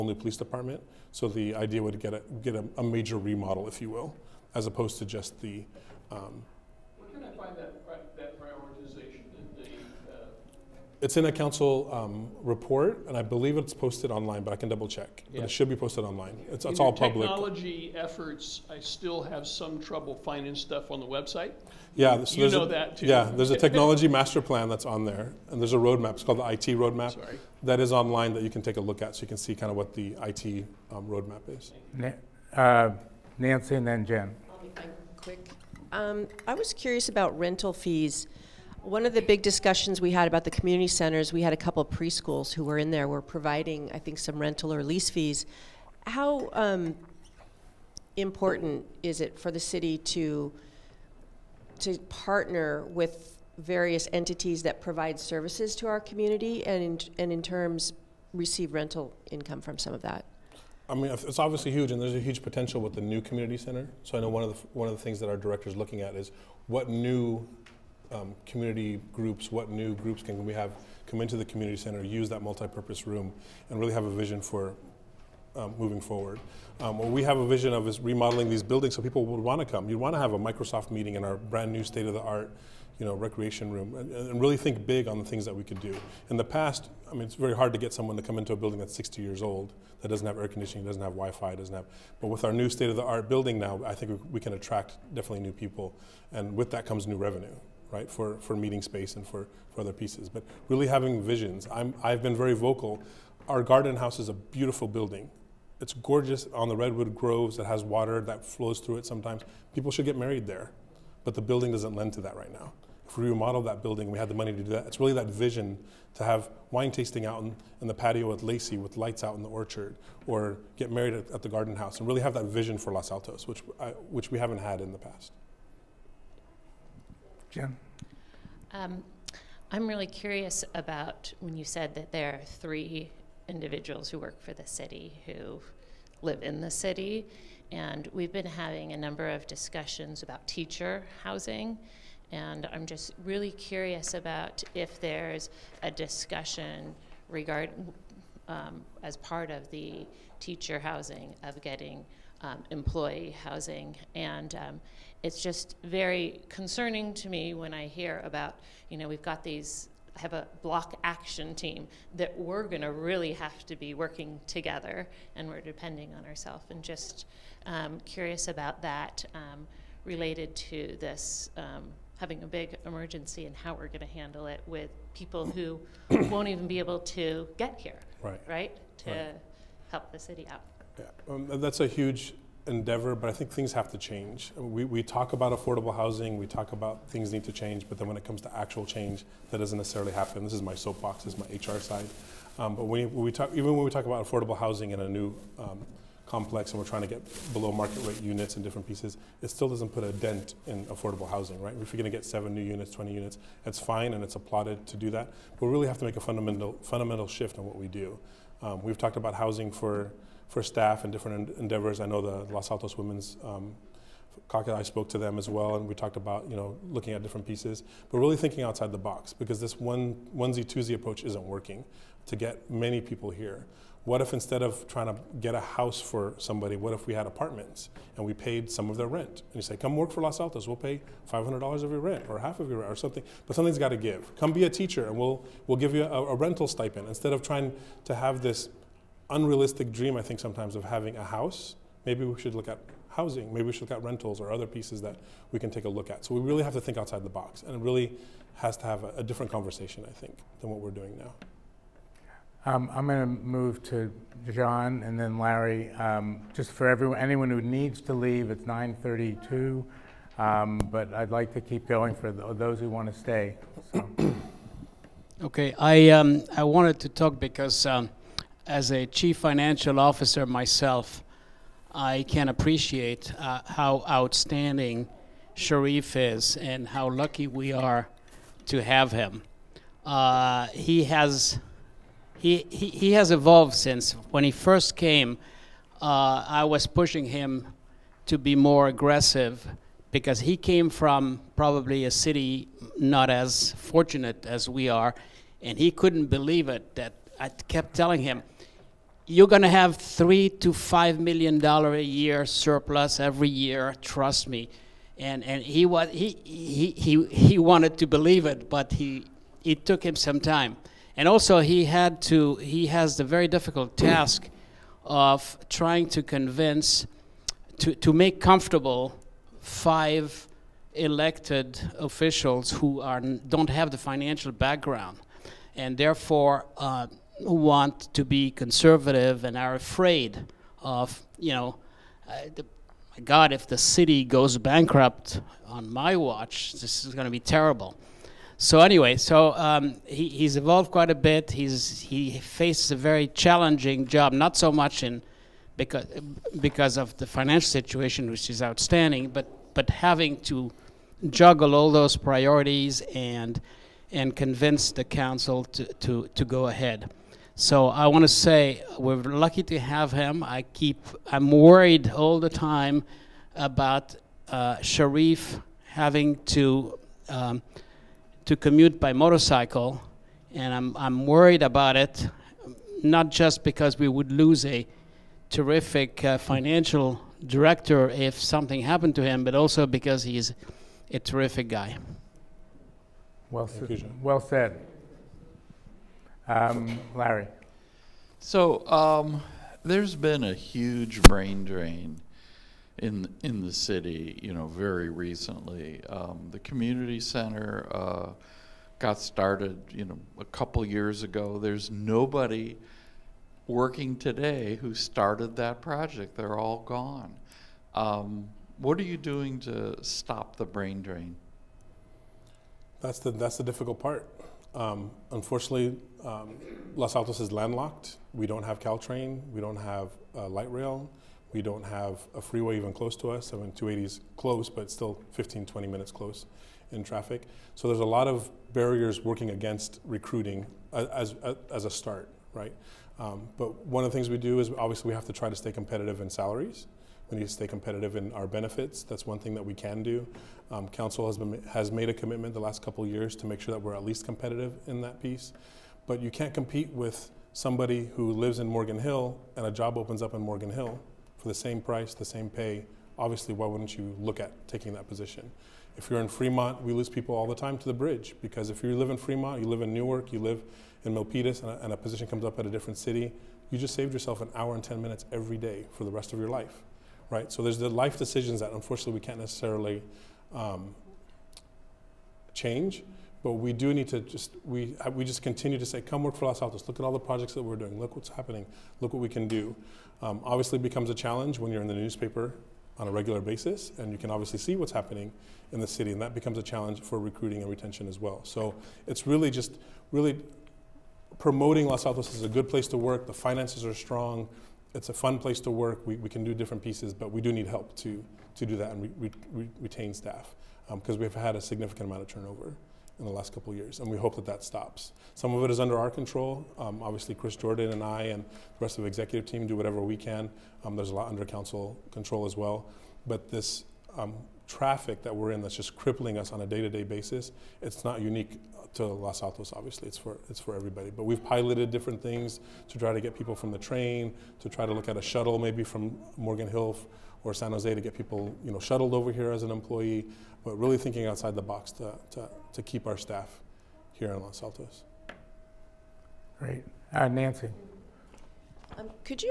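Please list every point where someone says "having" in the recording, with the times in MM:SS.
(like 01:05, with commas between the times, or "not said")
01:40, 02:18, 02:52, 04:00, 05:49, 06:05.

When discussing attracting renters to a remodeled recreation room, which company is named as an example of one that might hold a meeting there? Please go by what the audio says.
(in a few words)
Microsoft.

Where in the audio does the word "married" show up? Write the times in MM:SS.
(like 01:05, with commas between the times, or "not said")
01:50, 02:00.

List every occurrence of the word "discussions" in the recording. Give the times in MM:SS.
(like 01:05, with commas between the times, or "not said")
00:39, 02:19, 02:25.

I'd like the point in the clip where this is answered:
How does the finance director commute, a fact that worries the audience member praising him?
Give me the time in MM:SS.
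06:09.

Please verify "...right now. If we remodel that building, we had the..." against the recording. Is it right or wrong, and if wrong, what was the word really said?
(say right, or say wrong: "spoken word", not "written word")
right.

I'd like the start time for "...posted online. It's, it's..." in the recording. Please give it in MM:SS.
00:15.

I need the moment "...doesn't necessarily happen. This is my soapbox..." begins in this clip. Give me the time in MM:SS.
03:09.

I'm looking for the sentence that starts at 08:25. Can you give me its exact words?
Some of it is under our control.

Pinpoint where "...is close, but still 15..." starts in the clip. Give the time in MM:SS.
07:04.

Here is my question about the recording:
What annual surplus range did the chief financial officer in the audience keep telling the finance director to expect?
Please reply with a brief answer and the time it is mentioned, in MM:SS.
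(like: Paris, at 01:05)
3 to 5 million dollars, at 04:59.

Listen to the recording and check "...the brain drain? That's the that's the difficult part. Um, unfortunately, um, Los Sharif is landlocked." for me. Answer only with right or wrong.
wrong.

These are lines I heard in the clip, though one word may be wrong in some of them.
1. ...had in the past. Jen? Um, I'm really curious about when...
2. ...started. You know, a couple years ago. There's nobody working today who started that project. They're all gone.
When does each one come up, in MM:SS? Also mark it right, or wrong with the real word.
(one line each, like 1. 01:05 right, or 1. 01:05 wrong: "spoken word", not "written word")
1. 02:04 right
2. 06:39 right.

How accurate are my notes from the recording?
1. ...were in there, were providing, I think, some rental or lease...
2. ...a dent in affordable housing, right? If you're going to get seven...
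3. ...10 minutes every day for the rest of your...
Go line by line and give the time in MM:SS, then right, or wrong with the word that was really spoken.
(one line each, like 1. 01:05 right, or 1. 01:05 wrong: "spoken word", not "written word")
1. 00:42 right
2. 03:20 right
3. 07:44 right.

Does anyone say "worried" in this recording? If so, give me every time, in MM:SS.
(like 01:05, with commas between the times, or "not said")
06:01, 06:11.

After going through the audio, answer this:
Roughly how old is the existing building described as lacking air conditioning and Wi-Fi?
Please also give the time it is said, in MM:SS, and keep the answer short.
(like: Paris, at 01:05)
60 years, at 01:28.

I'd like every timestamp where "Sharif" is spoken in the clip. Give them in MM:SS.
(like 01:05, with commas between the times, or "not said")
04:35, 06:04.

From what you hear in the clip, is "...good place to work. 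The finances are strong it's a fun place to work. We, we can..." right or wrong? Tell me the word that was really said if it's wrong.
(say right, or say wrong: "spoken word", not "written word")
right.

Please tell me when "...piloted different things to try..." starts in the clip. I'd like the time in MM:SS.
08:41.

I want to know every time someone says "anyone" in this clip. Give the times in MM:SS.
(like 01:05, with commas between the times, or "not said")
04:17.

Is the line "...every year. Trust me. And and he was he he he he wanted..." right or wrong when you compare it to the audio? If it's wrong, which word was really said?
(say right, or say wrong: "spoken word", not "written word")
right.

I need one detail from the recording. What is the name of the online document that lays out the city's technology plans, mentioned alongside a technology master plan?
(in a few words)
IT roadmap.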